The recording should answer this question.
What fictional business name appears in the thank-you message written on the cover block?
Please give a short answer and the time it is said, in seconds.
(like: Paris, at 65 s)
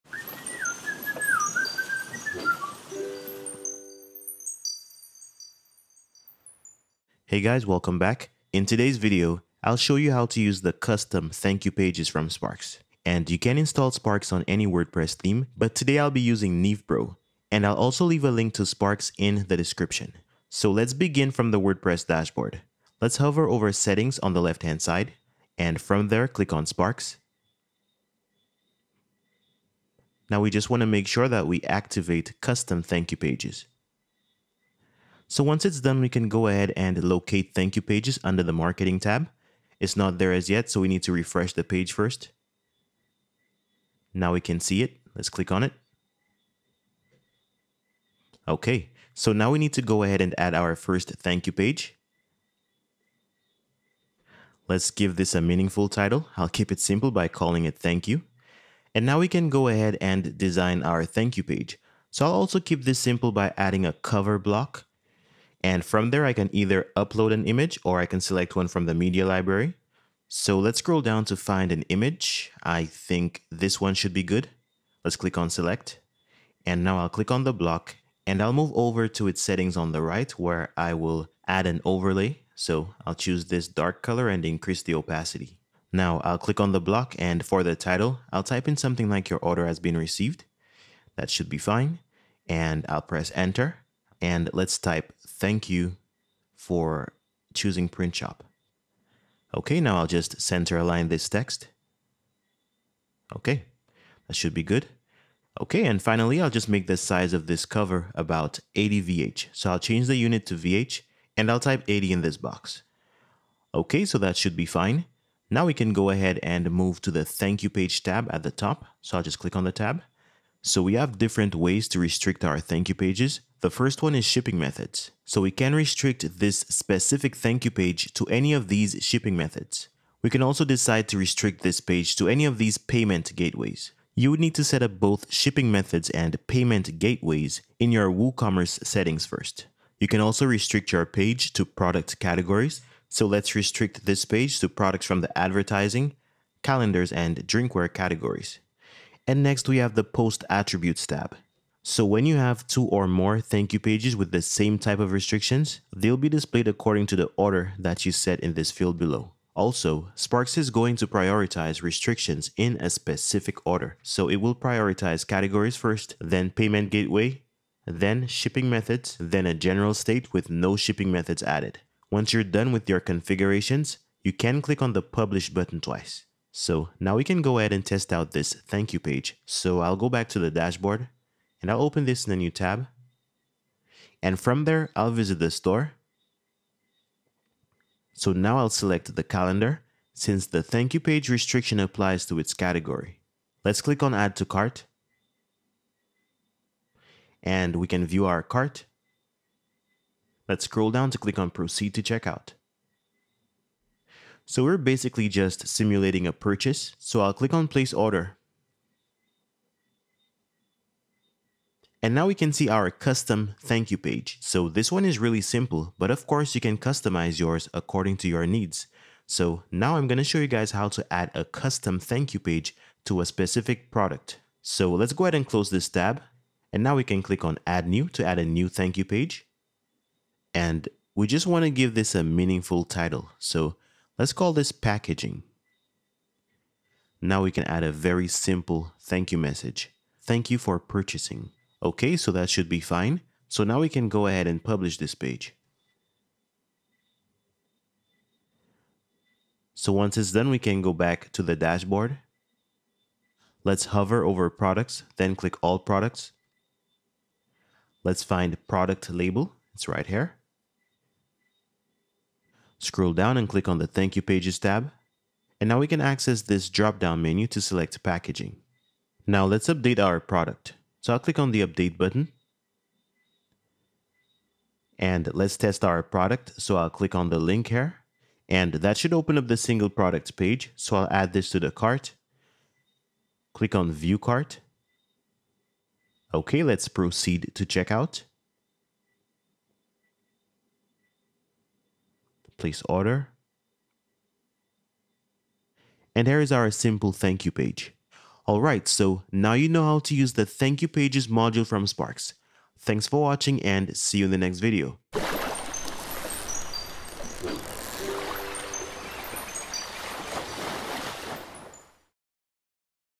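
print shop, at 97 s.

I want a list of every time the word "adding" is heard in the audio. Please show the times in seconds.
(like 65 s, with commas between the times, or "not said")
63 s.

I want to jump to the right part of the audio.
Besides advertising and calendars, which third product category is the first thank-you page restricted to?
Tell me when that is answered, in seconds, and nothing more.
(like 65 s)
147 s.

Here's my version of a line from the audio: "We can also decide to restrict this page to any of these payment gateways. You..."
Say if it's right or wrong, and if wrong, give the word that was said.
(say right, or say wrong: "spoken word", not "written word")
right.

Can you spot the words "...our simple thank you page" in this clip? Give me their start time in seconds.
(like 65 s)
296 s.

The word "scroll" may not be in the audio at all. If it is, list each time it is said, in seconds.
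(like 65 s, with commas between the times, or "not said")
70 s, 200 s, 262 s.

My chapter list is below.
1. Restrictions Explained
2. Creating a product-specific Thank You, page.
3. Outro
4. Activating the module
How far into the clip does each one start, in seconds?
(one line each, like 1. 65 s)
1. 119 s
2. 218 s
3. 296 s
4. 26 s.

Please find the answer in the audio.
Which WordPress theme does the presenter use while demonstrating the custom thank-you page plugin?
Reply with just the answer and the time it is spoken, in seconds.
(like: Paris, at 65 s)
Neve Pro, at 16 s.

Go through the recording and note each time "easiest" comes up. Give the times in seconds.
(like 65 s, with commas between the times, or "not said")
not said.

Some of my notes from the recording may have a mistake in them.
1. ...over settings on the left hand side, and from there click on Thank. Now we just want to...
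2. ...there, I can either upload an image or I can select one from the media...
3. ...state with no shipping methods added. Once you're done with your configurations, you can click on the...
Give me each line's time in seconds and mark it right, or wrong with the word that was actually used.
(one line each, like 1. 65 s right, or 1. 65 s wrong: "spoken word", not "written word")
1. 23 s wrong: "Sparks", not "Thank"
2. 66 s right
3. 169 s right.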